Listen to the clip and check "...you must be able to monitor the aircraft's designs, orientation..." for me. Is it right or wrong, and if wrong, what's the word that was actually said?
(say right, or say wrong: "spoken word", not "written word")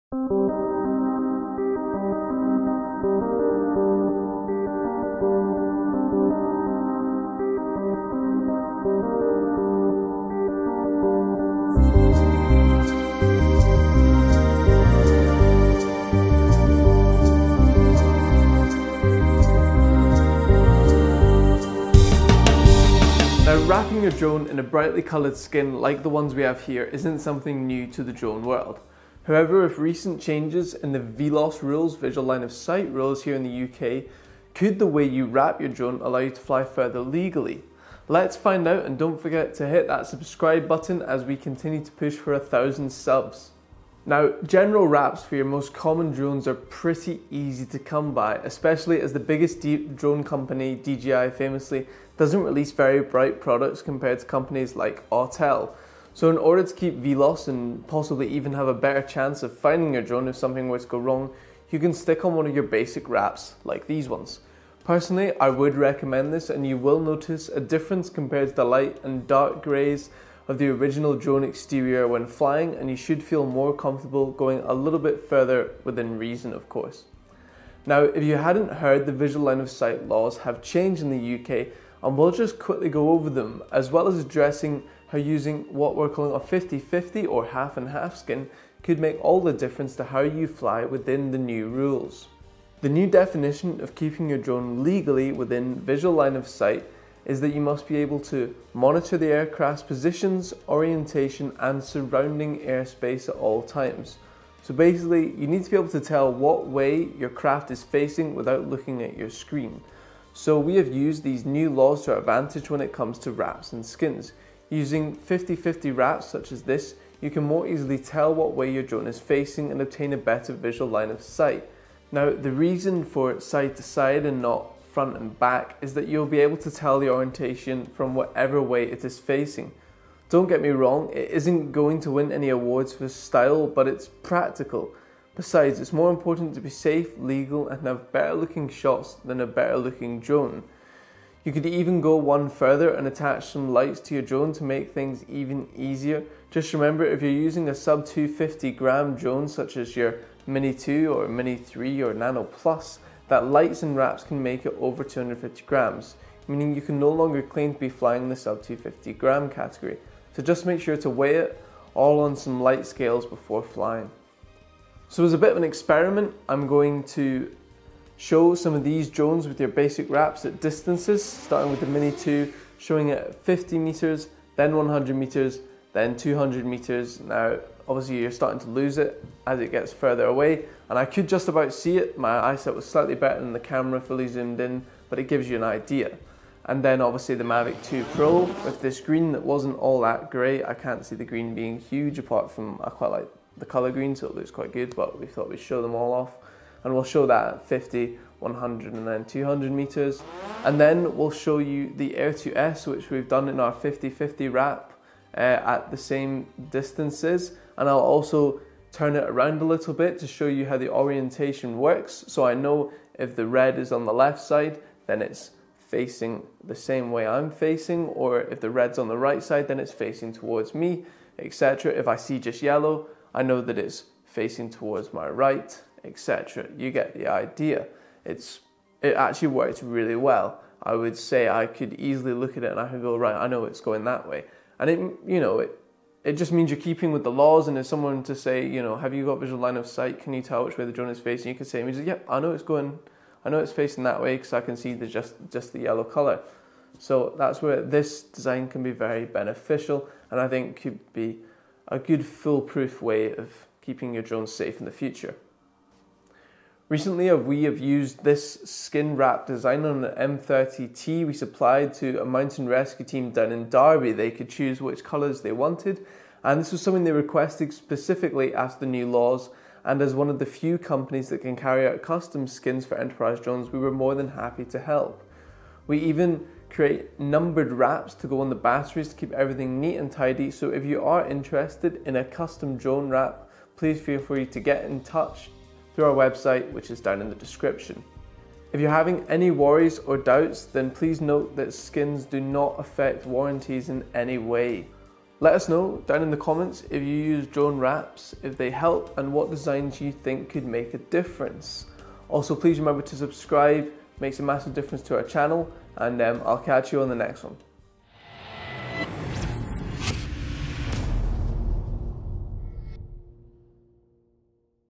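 wrong: "positions", not "designs".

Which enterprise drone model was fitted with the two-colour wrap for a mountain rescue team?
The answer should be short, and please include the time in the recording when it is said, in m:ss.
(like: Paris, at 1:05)
M30T, at 4:20.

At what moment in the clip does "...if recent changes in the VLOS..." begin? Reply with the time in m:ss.
0:29.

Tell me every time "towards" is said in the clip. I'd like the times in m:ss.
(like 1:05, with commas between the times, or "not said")
3:40, 3:44.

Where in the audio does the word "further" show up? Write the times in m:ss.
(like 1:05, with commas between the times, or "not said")
0:36, 1:15, 2:22, 2:59.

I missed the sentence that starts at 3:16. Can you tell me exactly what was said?
And we'll show that at 50, 100 and then 200 meters.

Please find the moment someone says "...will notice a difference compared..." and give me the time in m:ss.
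1:06.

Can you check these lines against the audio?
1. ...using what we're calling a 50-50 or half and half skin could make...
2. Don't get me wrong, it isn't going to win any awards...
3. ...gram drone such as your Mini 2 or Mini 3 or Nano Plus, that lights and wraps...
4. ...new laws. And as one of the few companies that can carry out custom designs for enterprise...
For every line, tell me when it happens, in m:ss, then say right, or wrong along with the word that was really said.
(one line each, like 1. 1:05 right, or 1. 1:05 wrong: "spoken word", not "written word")
1. 1:25 right
2. 2:10 right
3. 2:28 right
4. 4:28 wrong: "skins", not "designs".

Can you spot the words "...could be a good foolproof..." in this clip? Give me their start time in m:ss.
4:10.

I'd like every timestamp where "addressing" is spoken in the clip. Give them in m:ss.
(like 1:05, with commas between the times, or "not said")
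1:24.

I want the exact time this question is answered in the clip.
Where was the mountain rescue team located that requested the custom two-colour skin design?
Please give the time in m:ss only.
4:23.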